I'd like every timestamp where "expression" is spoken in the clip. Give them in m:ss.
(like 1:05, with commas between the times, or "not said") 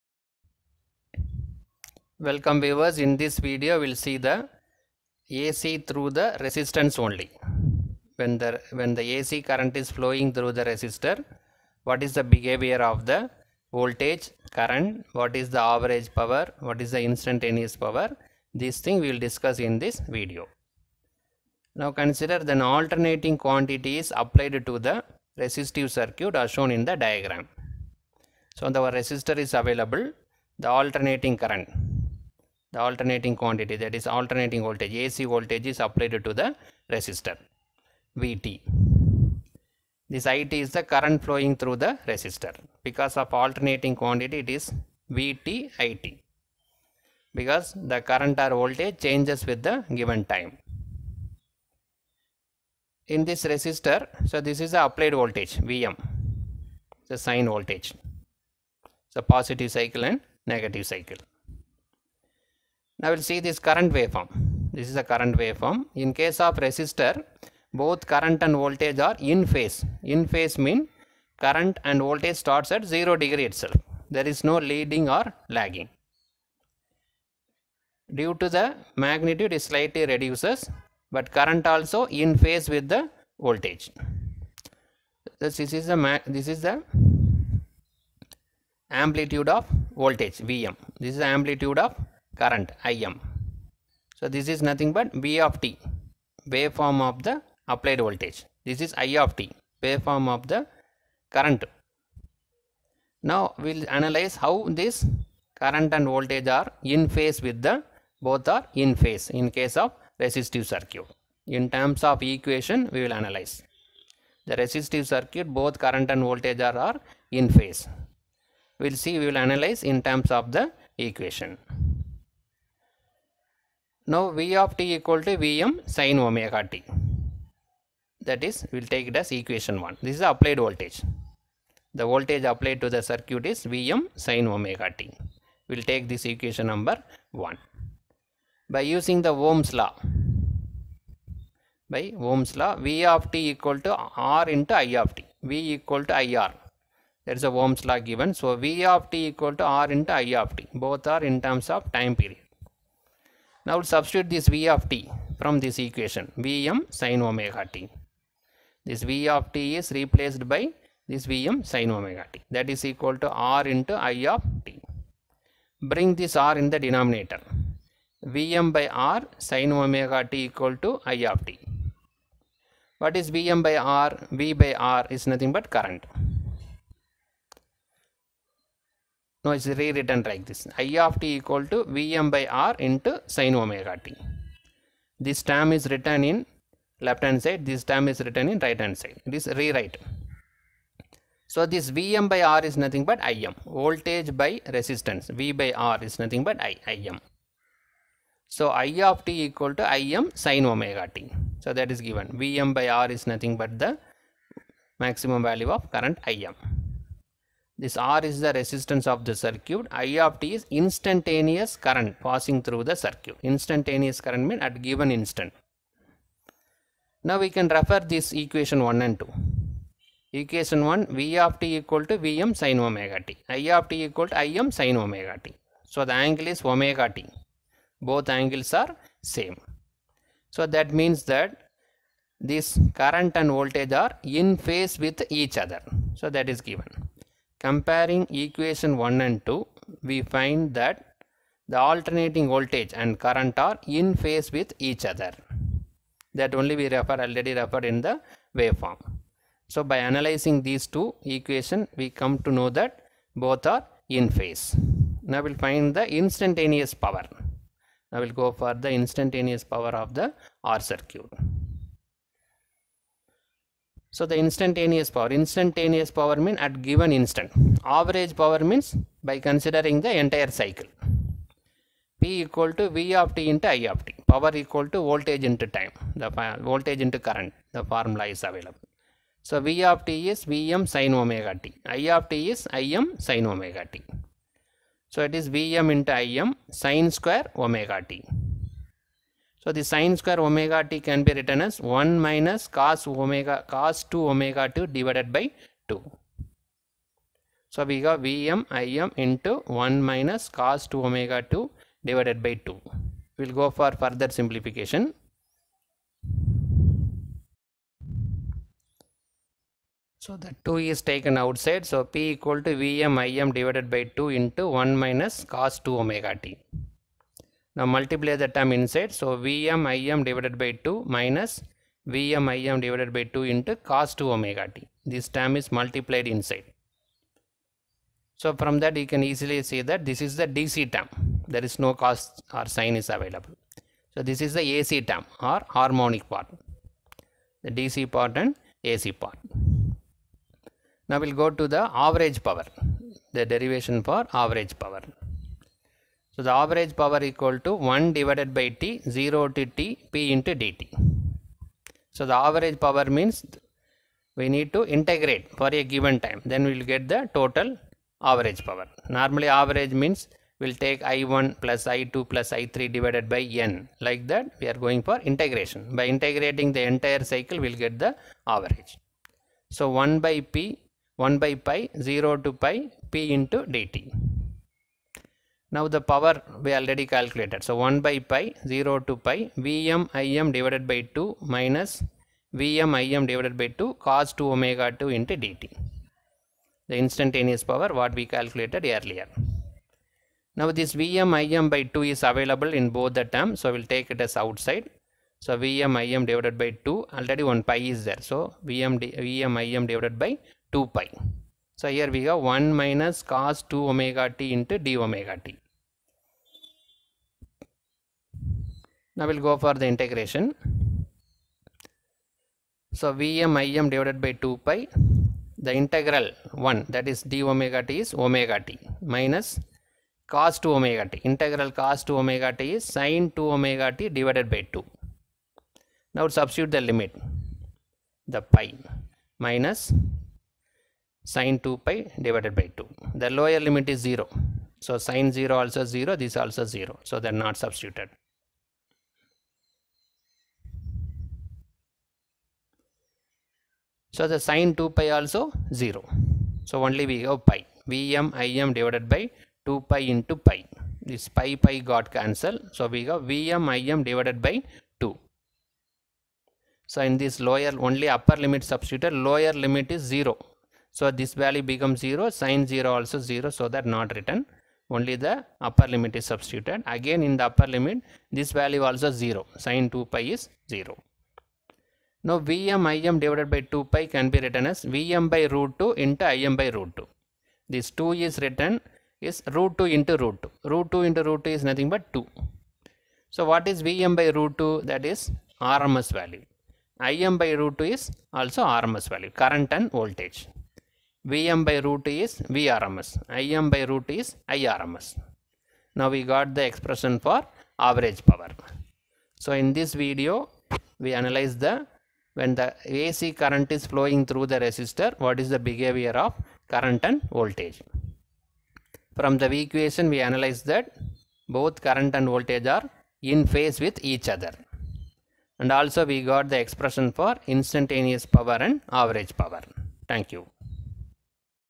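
8:16, 8:36.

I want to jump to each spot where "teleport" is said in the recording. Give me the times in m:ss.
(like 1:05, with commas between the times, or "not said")
not said.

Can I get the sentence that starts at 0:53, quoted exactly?
In this resistor, so this is the applied voltage Vm, the sine voltage, the positive cycle and negative cycle.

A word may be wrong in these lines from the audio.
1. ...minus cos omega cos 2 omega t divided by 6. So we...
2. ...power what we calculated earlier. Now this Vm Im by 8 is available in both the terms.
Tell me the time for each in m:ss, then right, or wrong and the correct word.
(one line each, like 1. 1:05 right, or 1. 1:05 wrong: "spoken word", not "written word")
1. 4:52 wrong: "2", not "6"
2. 6:27 wrong: "2", not "8".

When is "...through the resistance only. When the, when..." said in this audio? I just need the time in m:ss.
0:05.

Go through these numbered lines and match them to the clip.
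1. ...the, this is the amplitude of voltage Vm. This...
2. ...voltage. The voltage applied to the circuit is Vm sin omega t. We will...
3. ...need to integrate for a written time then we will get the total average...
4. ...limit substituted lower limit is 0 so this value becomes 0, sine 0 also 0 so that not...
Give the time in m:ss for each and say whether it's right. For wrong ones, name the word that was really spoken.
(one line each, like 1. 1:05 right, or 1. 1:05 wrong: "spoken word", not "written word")
1. 1:25 right
2. 2:10 right
3. 5:54 wrong: "given", not "written"
4. 7:38 right.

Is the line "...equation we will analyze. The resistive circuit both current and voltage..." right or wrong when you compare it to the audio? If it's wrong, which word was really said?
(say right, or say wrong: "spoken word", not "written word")
right.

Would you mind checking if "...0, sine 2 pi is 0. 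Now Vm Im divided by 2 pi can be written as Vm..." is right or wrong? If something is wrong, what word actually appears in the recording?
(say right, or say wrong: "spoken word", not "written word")
right.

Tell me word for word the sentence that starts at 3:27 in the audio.
This R is the resistance of the circuit.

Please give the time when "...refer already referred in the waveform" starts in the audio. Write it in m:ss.
4:06.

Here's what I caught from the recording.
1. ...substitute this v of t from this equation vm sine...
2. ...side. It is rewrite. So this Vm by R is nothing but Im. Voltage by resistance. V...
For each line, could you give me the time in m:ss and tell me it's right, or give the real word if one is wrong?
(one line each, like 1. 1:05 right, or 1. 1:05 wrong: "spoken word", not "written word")
1. 2:33 right
2. 3:08 right.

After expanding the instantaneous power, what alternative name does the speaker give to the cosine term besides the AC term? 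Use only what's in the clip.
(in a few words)
harmonic part.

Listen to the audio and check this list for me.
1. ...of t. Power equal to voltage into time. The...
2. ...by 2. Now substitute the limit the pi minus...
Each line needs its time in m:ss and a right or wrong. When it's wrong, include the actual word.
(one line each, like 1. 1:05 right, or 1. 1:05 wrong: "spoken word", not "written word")
1. 4:33 right
2. 7:04 right.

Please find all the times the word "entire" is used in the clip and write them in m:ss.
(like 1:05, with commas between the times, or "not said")
4:30, 6:06.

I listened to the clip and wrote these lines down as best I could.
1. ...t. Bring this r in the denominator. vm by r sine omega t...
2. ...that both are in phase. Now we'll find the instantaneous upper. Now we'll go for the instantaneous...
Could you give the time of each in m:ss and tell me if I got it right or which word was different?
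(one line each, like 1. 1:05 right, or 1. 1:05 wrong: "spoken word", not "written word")
1. 2:44 right
2. 4:12 wrong: "power", not "upper".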